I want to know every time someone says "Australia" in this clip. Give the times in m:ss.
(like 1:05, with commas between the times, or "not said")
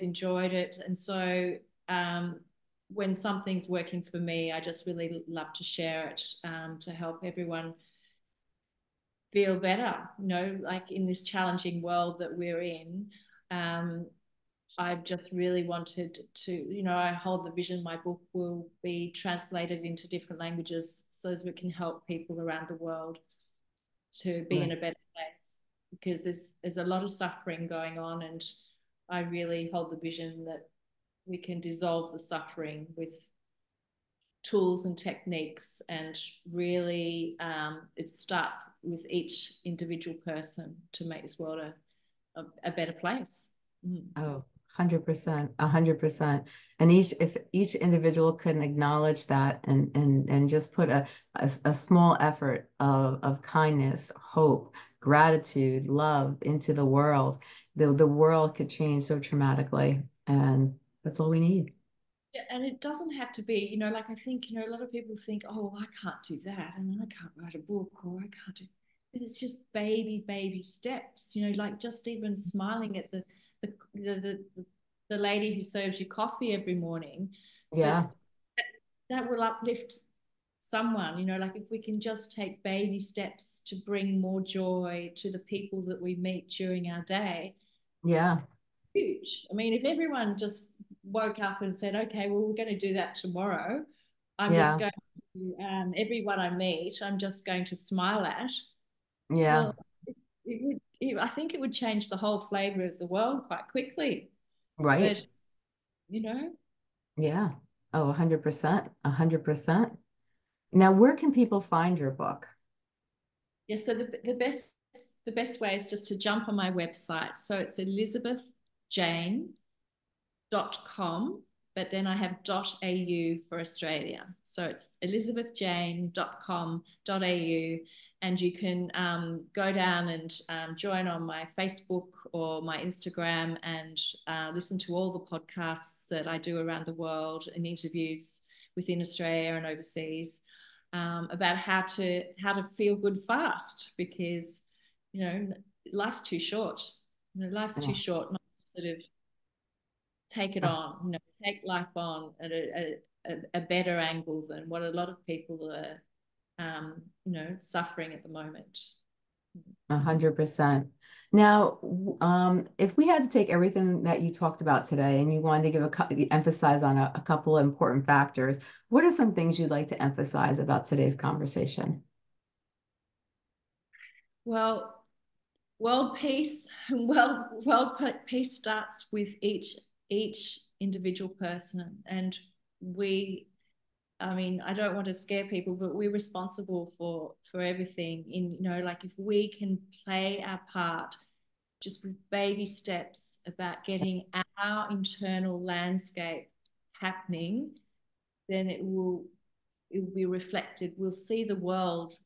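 2:03, 2:19.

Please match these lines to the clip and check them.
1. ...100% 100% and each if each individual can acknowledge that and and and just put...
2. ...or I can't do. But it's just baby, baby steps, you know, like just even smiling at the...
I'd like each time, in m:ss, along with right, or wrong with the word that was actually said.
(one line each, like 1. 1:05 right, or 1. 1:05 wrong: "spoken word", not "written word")
1. 0:44 right
2. 1:08 right.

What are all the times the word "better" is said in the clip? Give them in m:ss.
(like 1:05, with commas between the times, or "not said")
0:09, 0:24, 0:42, 2:33.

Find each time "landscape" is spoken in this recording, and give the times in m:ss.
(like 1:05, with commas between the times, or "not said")
3:15.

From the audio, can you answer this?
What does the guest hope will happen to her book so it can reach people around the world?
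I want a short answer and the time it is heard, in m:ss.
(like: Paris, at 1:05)
Translated into different languages, at 0:19.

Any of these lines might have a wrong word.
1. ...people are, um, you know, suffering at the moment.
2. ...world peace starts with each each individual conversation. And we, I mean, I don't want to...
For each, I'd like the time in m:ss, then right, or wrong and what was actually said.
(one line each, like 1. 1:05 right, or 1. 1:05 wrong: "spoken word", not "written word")
1. 2:35 right
2. 2:57 wrong: "person", not "conversation".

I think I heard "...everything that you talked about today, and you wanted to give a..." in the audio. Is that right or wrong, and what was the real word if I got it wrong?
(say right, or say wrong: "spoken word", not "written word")
right.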